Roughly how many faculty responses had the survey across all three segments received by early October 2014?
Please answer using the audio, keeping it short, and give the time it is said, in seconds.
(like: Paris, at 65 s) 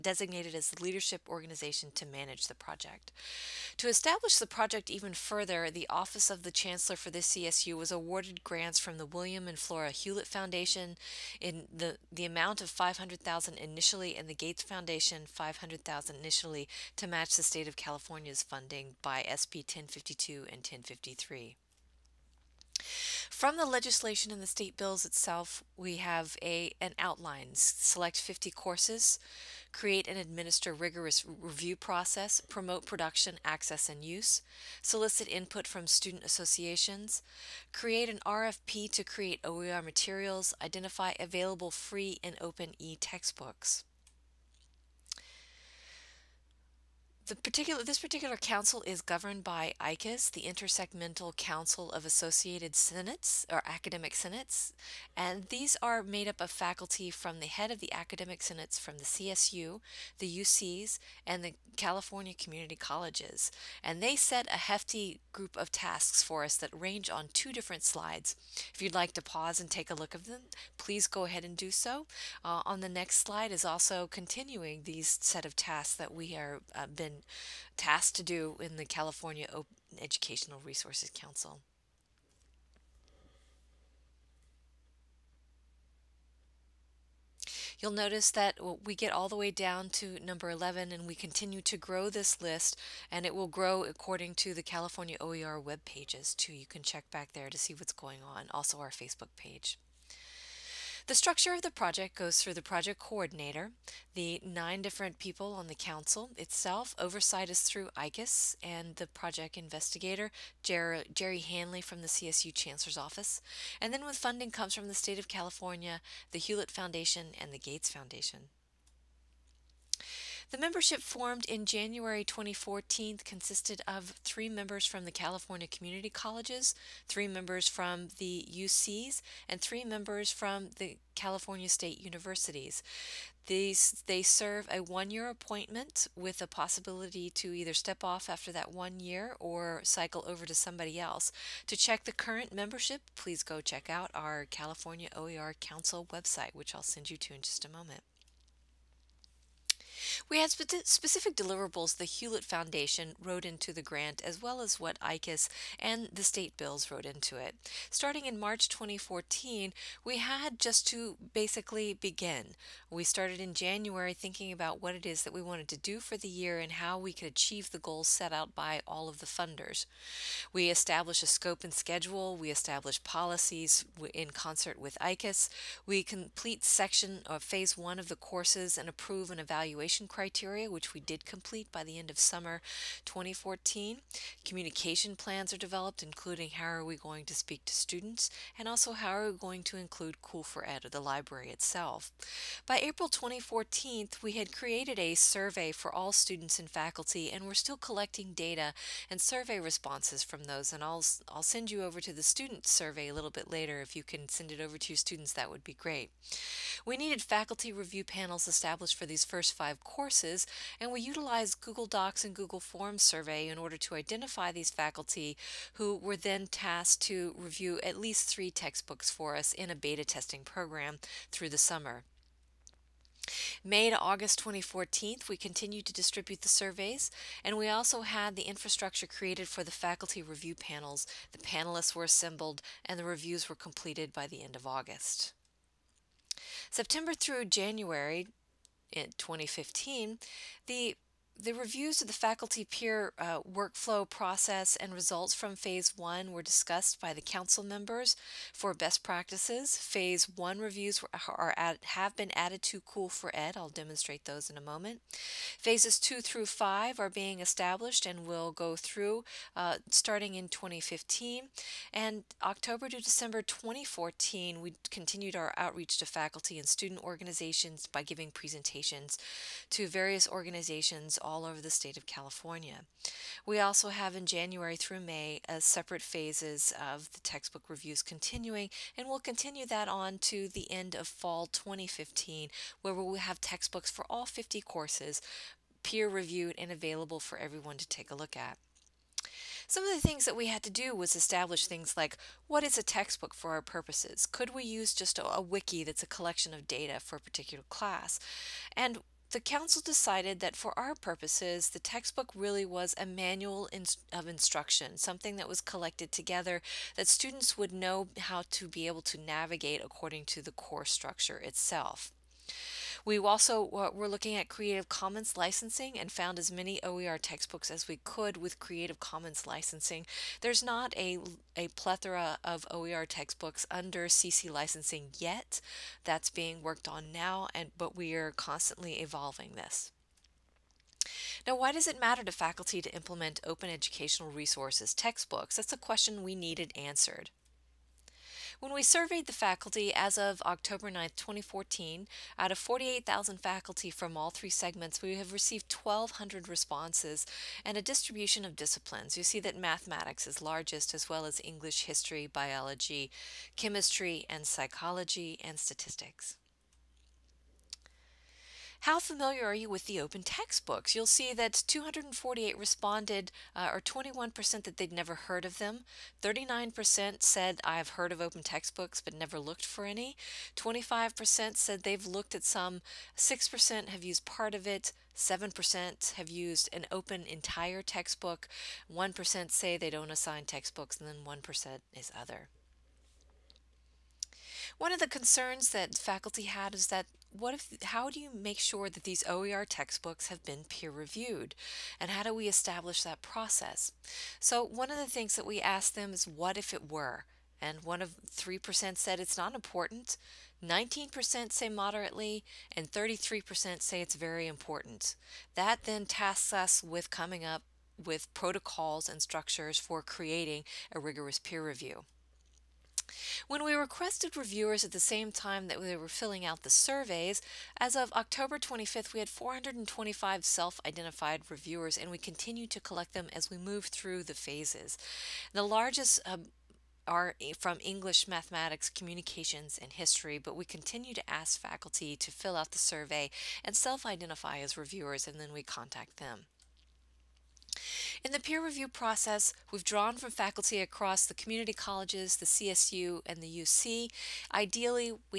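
1,200, at 345 s.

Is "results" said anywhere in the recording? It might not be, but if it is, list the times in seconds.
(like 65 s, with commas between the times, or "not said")
244 s.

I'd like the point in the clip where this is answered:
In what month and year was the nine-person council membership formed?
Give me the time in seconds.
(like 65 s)
121 s.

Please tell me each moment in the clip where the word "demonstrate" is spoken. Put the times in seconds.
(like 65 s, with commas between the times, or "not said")
253 s.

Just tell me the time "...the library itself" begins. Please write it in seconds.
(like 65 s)
190 s.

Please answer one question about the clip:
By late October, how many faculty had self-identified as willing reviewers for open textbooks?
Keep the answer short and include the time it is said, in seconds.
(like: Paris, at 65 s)
425, at 419 s.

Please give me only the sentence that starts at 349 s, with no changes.
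You see that mathematics is largest, as well as English, history, biology, chemistry, and psychology, and statistics.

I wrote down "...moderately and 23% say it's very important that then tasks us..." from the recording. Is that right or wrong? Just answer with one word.
wrong.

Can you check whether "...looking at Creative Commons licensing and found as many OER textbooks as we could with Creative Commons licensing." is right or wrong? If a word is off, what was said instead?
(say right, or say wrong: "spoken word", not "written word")
right.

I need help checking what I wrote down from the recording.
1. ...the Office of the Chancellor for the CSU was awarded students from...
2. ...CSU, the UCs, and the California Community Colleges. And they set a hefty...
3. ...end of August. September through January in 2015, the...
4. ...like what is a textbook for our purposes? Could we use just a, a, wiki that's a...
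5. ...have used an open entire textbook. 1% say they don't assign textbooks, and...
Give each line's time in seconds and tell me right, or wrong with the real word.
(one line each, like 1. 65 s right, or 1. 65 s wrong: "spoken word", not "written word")
1. 5 s wrong: "grants", not "students"
2. 59 s right
3. 234 s right
4. 291 s right
5. 376 s right.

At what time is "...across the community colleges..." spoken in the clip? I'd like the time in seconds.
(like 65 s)
440 s.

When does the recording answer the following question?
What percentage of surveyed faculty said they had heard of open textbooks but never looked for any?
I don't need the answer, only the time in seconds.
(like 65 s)
366 s.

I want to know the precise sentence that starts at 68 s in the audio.
If you'd like to pause and take a look at them, please go ahead and do so.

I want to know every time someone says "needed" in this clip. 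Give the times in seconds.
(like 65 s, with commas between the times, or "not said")
206 s, 336 s.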